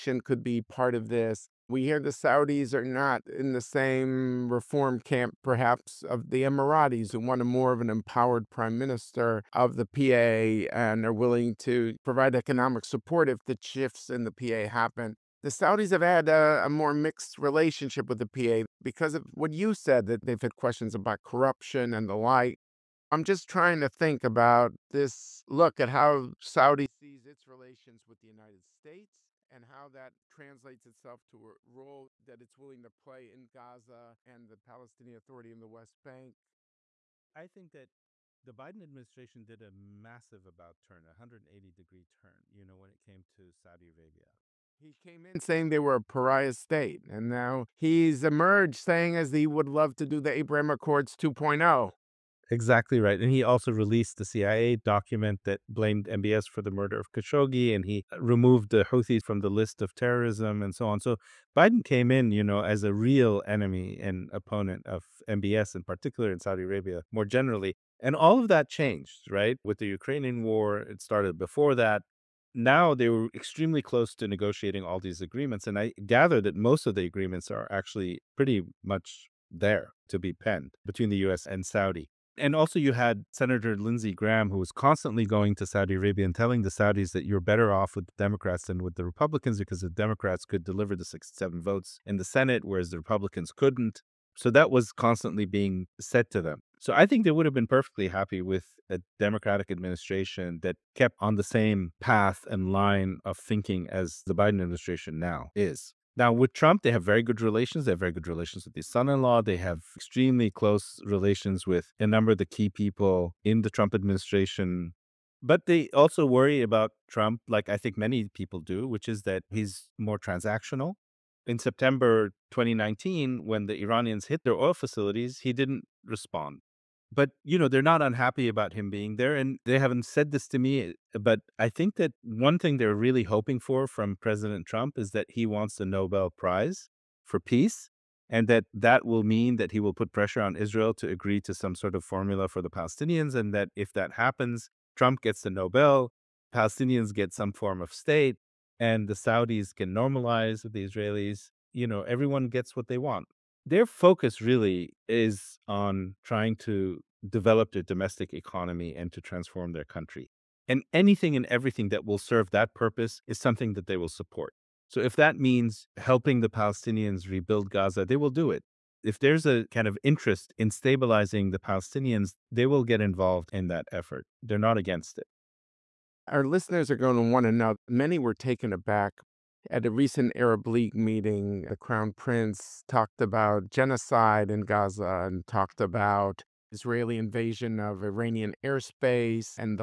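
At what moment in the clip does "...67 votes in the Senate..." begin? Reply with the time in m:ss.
1:31.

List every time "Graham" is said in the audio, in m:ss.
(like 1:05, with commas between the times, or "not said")
1:24.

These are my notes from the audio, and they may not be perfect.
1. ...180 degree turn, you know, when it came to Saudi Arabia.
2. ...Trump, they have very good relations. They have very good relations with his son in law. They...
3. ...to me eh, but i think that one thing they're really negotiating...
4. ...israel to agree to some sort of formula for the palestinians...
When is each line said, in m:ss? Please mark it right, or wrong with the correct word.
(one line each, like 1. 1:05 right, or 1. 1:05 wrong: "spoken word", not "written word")
1. 0:41 right
2. 1:46 right
3. 2:10 wrong: "hoping", not "negotiating"
4. 2:20 right.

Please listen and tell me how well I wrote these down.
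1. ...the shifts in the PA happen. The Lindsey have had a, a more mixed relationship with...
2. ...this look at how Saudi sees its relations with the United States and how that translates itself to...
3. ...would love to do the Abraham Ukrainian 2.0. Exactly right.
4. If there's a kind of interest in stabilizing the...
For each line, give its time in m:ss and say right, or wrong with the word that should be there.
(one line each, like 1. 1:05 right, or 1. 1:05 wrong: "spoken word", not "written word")
1. 0:13 wrong: "Saudis", not "Lindsey"
2. 0:24 right
3. 0:49 wrong: "Accords", not "Ukrainian"
4. 2:49 right.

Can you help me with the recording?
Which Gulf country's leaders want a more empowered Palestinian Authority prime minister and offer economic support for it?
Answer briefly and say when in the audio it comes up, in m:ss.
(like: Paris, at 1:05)
Emiratis, at 0:06.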